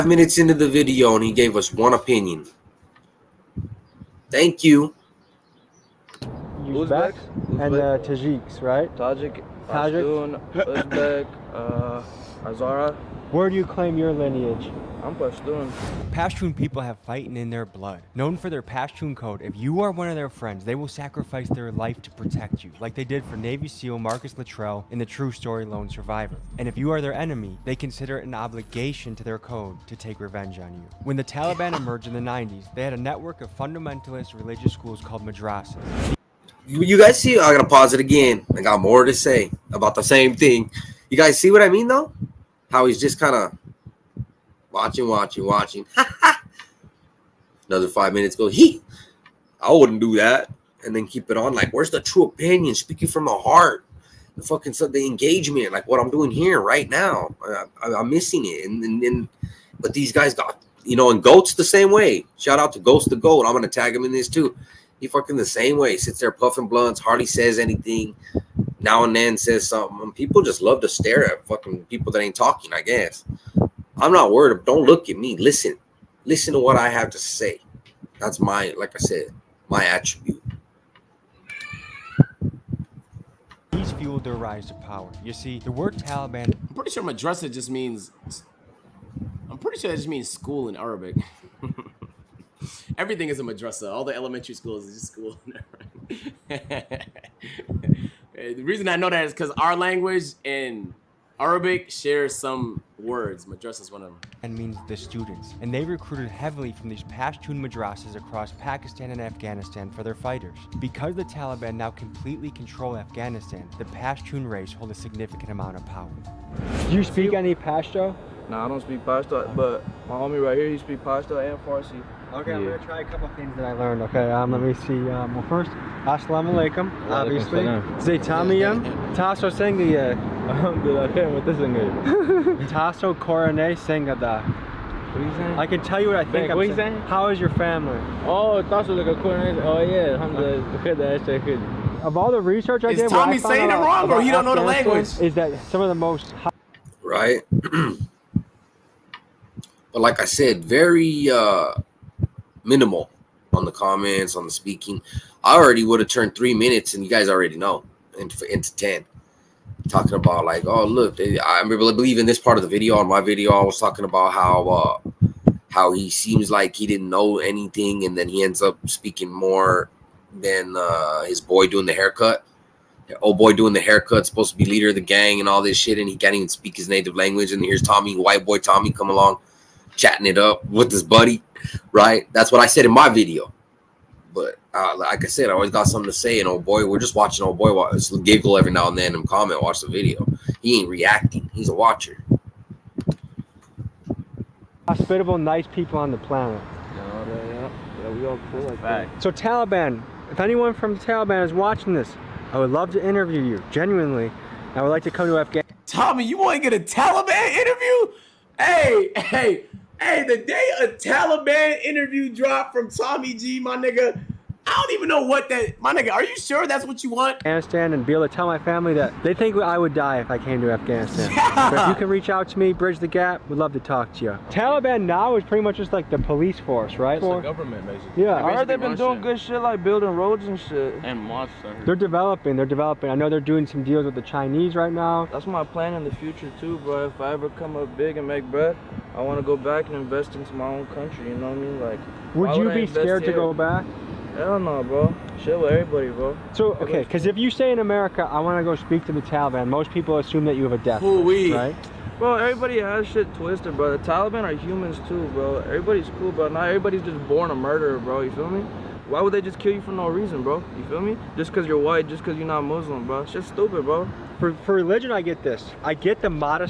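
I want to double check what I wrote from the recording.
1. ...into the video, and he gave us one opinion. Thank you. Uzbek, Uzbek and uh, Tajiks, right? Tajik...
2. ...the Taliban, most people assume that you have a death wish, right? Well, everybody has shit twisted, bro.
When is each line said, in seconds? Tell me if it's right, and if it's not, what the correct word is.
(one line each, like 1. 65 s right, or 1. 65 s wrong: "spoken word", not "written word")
1. 0 s right
2. 249 s right.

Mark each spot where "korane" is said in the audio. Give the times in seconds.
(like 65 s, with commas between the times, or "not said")
133 s, 139 s.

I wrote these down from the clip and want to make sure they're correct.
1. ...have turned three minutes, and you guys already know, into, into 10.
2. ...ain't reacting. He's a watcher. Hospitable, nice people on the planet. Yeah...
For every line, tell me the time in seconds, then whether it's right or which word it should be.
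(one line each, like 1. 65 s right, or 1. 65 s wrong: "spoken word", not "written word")
1. 155 s right
2. 190 s right.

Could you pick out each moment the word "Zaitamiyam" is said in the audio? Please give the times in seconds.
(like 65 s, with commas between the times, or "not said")
127 s.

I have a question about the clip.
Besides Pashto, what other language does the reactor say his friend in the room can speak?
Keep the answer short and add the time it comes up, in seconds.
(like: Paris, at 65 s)
Farsi, at 121 s.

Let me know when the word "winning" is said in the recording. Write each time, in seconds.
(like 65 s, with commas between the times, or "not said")
not said.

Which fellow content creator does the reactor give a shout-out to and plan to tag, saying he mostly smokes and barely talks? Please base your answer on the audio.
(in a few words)
Ghost the Goat.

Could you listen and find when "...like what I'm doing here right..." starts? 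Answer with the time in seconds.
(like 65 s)
55 s.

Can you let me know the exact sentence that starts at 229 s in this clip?
good shit like building roads and shit.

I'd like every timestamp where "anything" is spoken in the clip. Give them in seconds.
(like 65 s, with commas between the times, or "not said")
67 s, 167 s.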